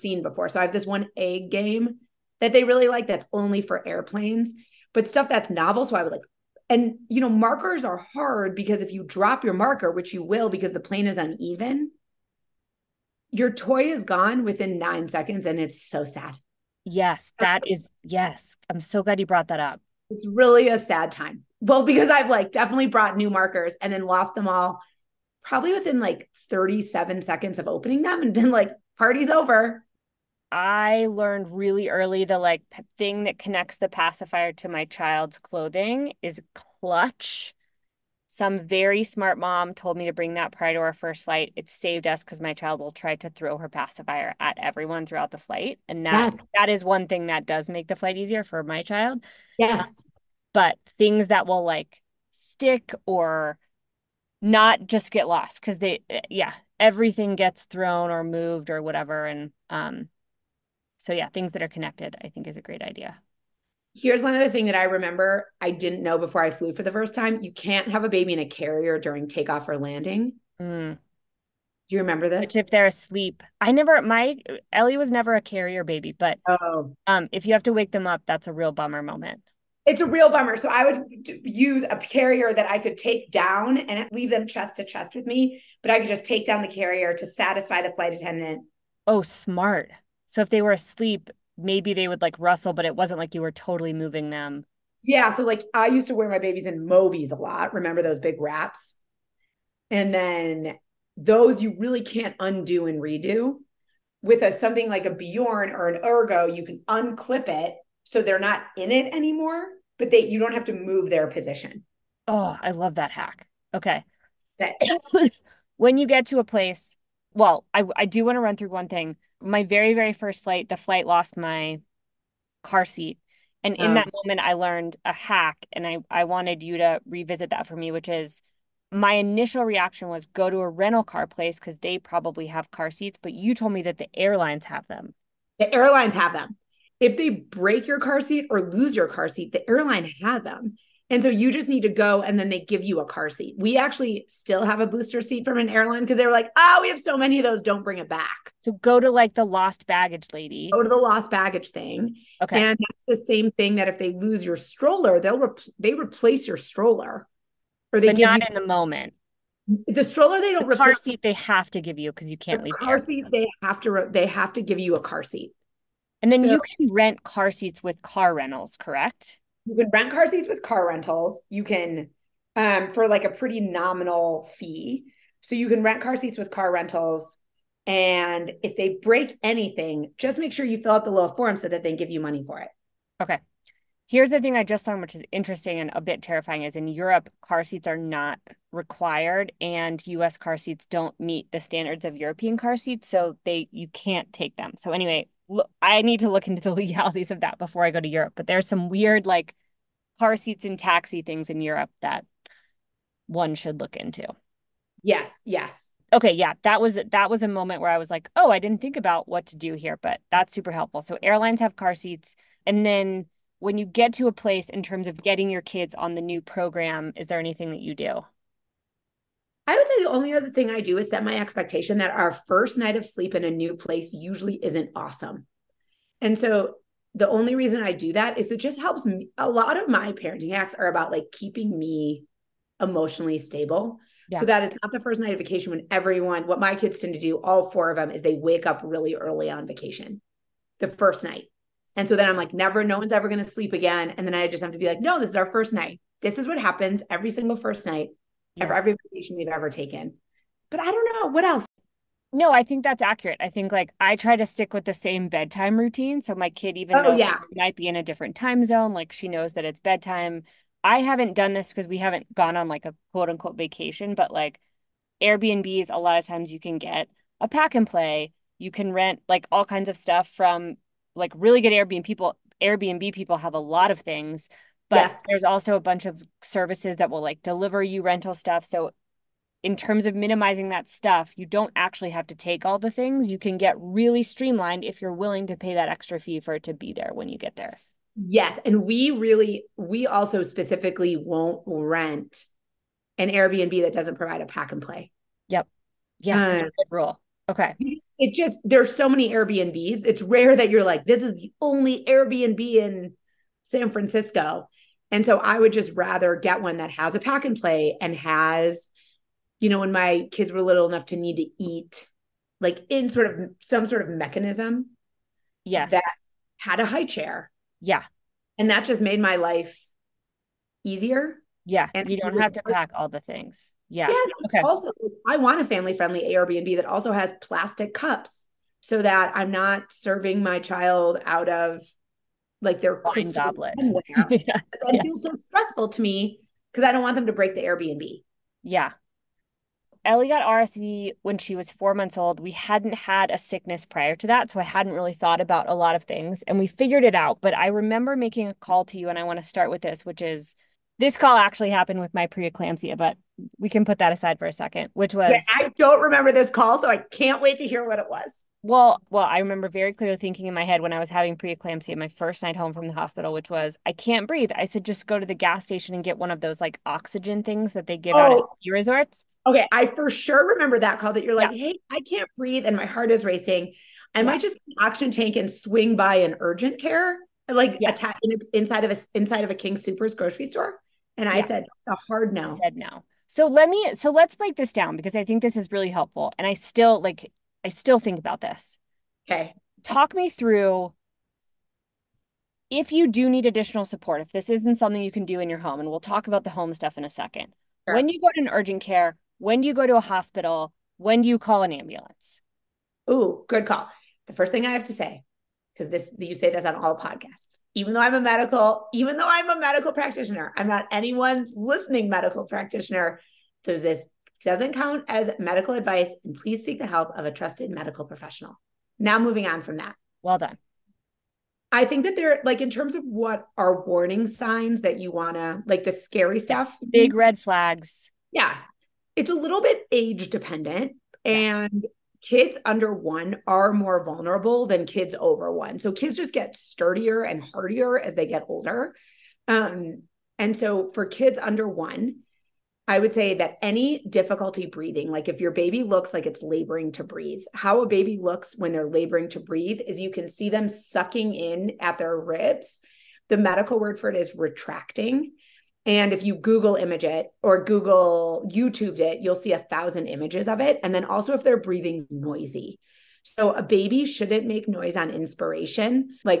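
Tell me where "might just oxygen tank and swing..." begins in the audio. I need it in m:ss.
6:14.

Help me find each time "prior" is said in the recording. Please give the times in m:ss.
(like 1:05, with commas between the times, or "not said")
0:40, 5:43.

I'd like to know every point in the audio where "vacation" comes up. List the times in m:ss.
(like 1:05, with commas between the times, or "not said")
3:55, 3:59, 4:09, 4:23.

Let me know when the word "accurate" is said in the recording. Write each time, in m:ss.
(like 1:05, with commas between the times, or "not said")
4:13.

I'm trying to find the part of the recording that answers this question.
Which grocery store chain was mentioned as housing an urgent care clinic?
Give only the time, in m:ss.
6:19.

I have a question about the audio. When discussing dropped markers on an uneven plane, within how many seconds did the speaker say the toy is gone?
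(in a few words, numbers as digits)
9.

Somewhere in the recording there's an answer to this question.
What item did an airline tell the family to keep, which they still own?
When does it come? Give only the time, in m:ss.
2:24.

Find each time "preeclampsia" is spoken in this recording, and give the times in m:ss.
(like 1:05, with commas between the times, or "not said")
5:52, 6:01.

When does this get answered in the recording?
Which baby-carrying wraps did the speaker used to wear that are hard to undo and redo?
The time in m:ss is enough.
1:36.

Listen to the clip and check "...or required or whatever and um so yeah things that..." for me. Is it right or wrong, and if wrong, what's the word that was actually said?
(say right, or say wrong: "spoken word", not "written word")
wrong: "moved", not "required".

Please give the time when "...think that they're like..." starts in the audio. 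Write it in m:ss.
7:01.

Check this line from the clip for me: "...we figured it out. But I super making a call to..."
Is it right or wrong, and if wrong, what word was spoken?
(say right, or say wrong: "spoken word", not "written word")
wrong: "remember", not "super".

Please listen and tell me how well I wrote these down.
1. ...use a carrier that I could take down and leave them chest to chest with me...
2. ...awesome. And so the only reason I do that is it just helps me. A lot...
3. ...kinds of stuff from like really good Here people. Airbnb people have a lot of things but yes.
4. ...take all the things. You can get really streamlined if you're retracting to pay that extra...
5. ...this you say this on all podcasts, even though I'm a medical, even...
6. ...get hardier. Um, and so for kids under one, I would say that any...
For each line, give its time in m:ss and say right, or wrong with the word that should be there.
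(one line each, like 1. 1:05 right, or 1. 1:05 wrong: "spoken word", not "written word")
1. 1:21 right
2. 3:44 right
3. 4:29 wrong: "Airbnb", not "Here"
4. 4:42 wrong: "willing", not "retracting"
5. 6:45 right
6. 7:18 wrong: "older", not "hardier".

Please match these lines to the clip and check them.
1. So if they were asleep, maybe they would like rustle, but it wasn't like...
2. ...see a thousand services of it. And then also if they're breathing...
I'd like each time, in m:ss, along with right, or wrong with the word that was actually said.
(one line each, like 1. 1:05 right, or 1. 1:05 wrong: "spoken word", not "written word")
1. 1:30 right
2. 7:39 wrong: "images", not "services".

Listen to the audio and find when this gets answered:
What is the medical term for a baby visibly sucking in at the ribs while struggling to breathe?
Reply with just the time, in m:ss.
7:34.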